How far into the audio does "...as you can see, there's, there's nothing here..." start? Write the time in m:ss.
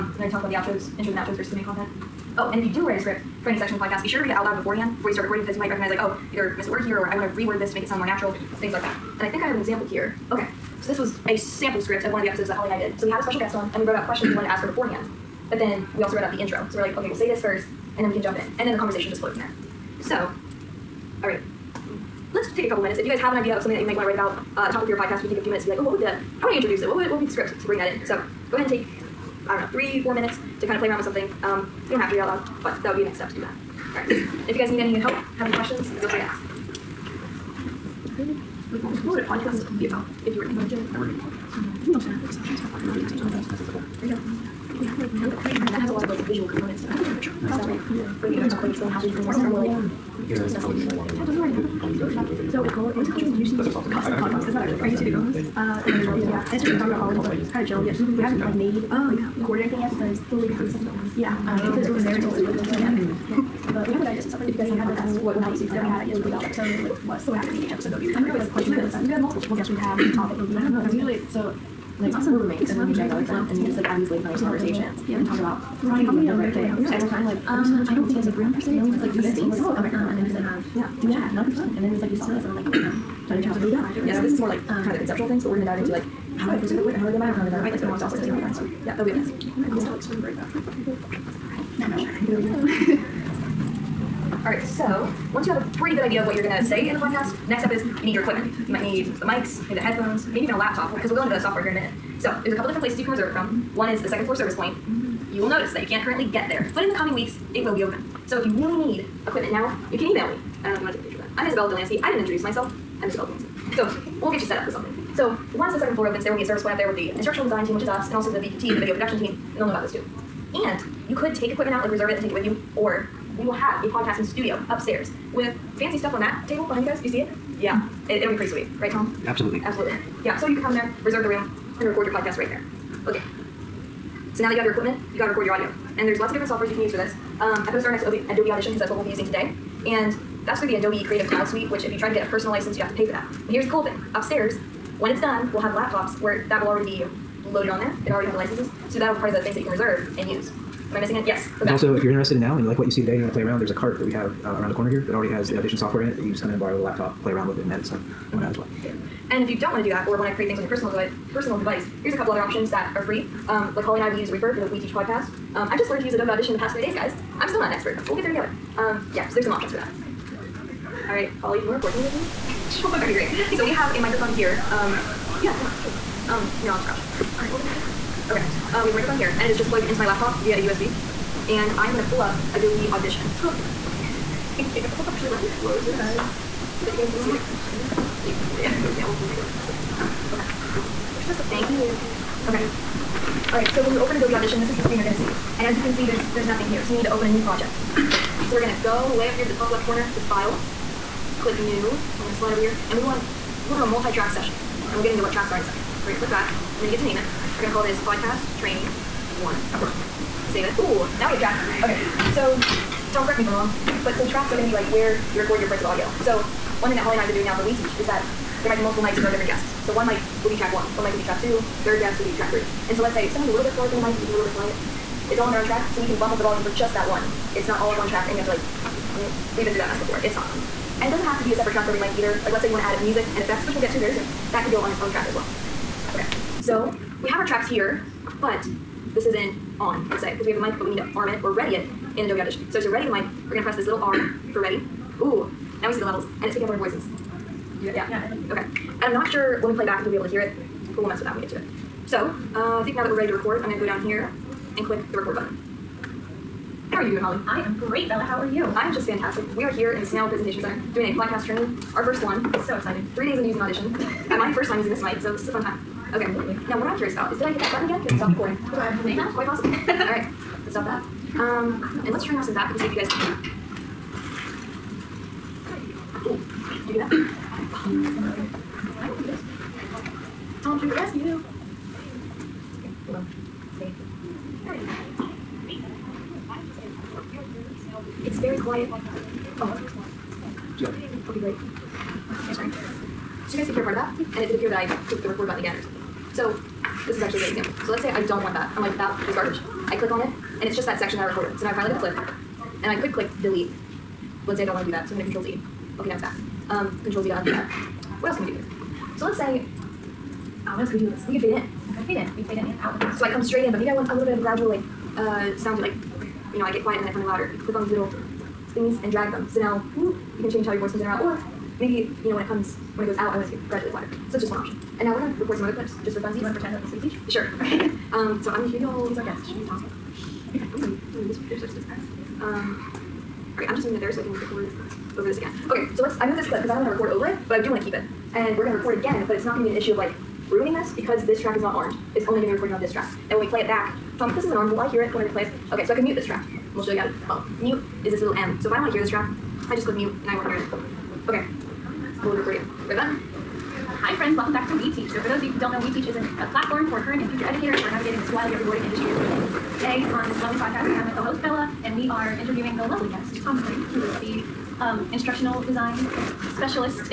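3:15.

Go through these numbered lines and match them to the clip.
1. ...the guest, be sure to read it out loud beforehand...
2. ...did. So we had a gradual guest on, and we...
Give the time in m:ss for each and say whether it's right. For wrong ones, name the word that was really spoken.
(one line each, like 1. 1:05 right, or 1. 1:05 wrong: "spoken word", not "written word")
1. 0:03 wrong: "podcast", not "guest"
2. 0:12 wrong: "special", not "gradual".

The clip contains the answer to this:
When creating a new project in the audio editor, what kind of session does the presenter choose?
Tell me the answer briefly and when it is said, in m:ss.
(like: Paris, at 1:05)
Multi-track session, at 3:23.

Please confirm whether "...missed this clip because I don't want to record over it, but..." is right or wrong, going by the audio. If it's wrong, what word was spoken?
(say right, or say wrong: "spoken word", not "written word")
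wrong: "moved", not "missed".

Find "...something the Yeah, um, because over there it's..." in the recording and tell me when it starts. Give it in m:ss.
1:00.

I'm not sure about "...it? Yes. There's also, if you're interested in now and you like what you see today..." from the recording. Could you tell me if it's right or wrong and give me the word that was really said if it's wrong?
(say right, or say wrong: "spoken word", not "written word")
right.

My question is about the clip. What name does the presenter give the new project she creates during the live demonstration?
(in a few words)
podcast training one.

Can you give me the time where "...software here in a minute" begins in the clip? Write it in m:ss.
1:41.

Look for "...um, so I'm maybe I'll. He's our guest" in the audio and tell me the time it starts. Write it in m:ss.
5:28.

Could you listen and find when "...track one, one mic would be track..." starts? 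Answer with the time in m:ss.
3:40.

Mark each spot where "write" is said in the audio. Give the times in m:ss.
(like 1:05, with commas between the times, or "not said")
0:02, 0:24.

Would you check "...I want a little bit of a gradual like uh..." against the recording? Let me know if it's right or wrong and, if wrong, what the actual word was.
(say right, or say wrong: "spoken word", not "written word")
right.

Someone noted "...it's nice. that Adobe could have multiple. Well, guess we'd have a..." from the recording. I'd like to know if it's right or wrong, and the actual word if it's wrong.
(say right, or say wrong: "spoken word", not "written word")
wrong: "You", not "Adobe".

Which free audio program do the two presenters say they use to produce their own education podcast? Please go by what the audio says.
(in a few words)
Reaper.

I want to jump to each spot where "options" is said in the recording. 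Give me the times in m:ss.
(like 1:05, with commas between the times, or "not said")
2:42, 2:49, 5:24.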